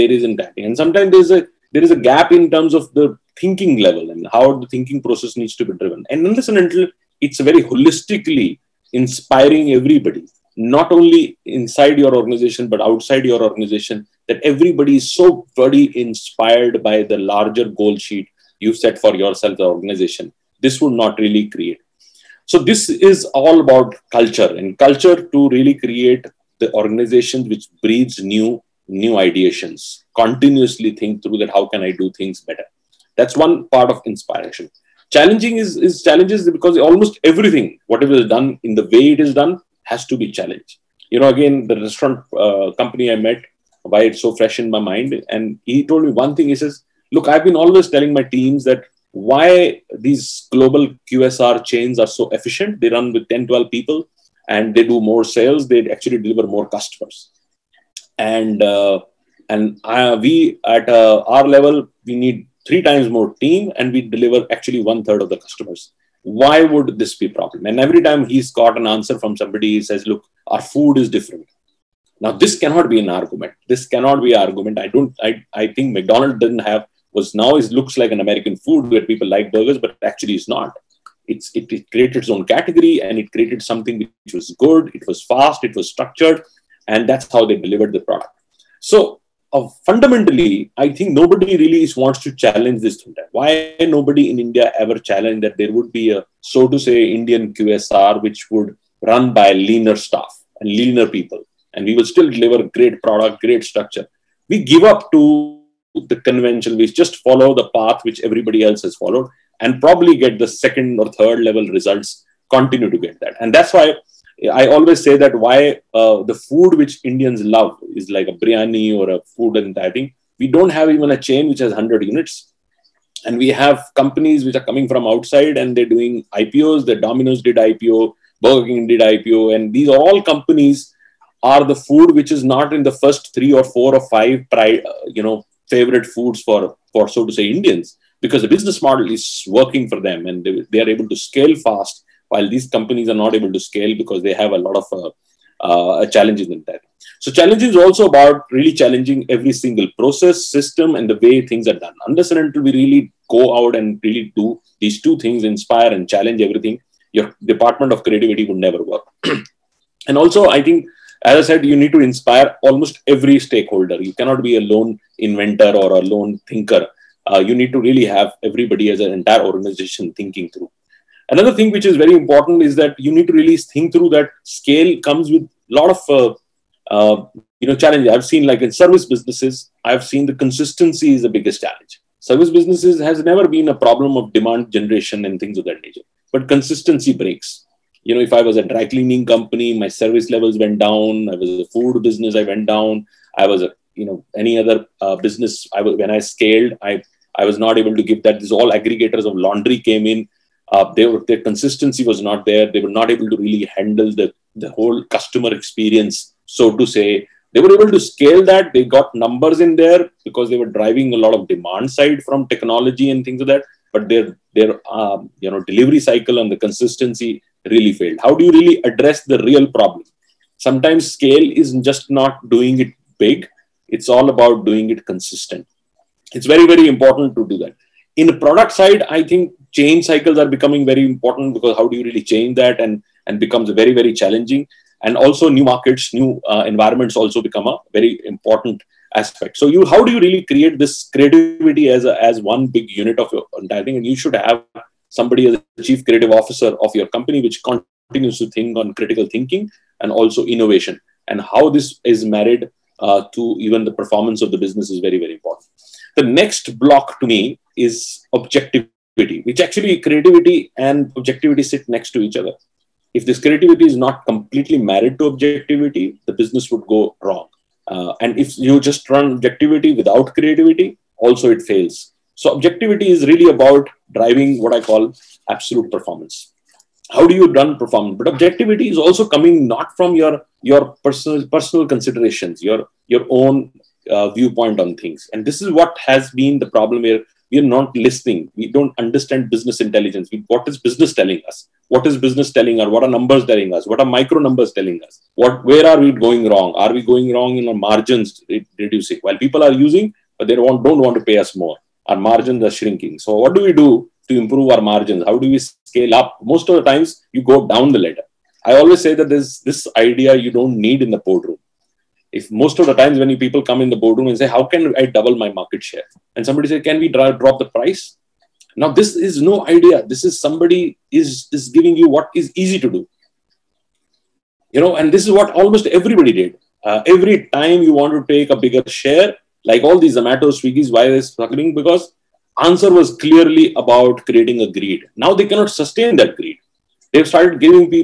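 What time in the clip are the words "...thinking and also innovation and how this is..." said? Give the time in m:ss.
4:09.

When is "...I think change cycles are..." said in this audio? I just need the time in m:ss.
3:49.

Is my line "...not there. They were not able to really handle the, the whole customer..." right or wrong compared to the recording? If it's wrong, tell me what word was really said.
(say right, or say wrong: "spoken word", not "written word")
right.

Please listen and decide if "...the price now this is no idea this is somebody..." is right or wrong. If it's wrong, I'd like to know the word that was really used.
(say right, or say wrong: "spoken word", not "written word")
right.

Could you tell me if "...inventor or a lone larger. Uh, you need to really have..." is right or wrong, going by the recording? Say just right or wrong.
wrong.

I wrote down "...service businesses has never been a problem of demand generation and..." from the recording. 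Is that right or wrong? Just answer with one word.
right.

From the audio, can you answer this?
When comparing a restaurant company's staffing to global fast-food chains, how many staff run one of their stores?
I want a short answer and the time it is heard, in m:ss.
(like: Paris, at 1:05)
10, 12, at 0:53.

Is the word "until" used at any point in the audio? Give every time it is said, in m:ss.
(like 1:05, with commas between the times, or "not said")
0:06, 2:32.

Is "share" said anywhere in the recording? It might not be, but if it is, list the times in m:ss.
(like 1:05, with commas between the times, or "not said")
5:15, 5:29.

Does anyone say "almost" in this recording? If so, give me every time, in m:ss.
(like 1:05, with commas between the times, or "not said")
0:36, 2:42, 5:25.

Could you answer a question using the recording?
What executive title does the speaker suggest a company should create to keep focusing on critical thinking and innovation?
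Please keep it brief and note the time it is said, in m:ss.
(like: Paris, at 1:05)
chief creative officer, at 4:05.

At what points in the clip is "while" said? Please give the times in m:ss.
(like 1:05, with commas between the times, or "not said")
2:22, 4:59.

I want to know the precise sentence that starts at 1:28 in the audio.
So uh, fundamentally, I think nobody really wants to challenge this thing.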